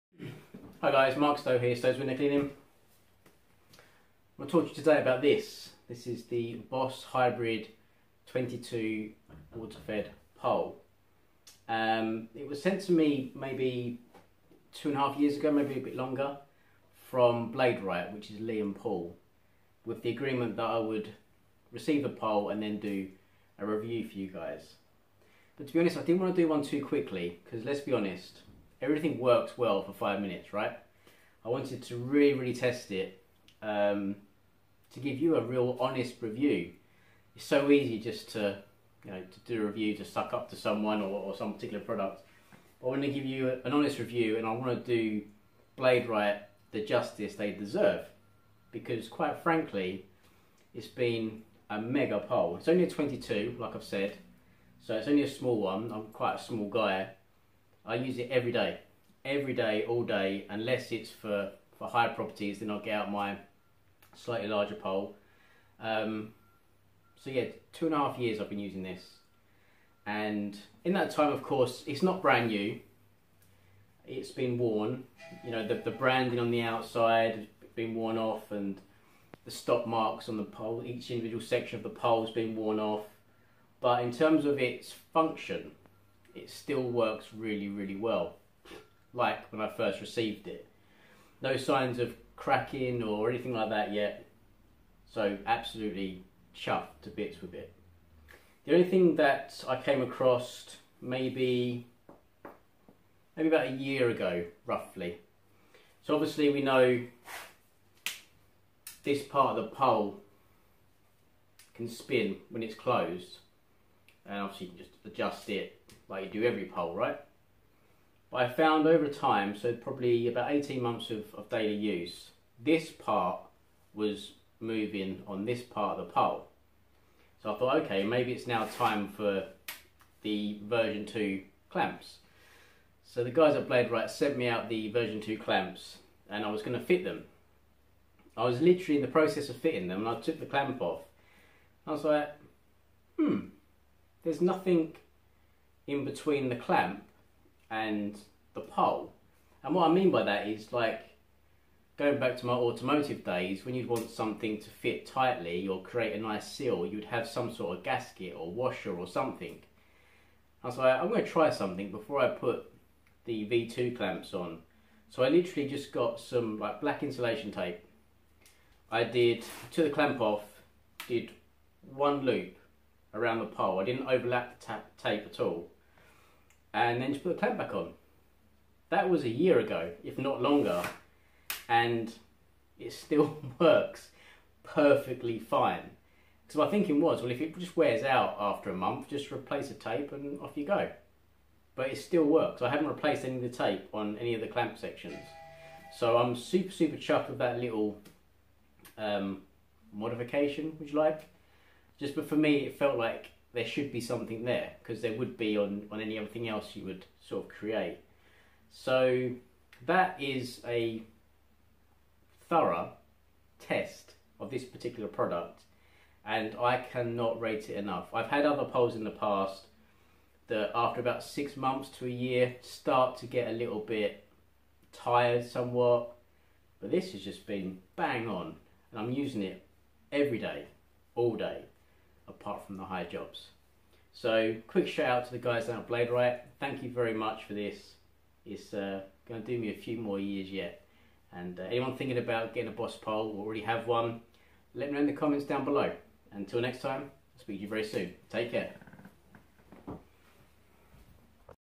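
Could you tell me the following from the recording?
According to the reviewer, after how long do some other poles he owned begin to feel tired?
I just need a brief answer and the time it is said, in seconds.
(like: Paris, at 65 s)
six months to a year, at 221 s.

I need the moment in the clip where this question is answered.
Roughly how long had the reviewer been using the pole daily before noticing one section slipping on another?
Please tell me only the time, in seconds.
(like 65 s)
120 s.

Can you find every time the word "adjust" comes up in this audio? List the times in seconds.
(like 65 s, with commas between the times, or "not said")
115 s.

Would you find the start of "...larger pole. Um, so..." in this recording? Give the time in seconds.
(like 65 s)
64 s.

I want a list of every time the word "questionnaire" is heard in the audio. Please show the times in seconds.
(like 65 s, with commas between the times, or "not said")
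not said.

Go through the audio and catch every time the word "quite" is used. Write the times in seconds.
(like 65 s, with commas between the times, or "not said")
49 s, 56 s.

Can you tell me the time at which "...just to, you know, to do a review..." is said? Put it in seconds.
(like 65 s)
37 s.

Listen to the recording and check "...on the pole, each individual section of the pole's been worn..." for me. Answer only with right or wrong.
right.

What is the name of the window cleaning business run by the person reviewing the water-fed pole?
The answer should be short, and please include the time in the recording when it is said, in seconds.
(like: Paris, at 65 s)
Stowe's Window Cleaning, at 1 s.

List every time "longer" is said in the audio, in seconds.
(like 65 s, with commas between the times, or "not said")
15 s, 180 s.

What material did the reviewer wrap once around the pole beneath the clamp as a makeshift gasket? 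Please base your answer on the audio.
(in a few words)
black insulation tape.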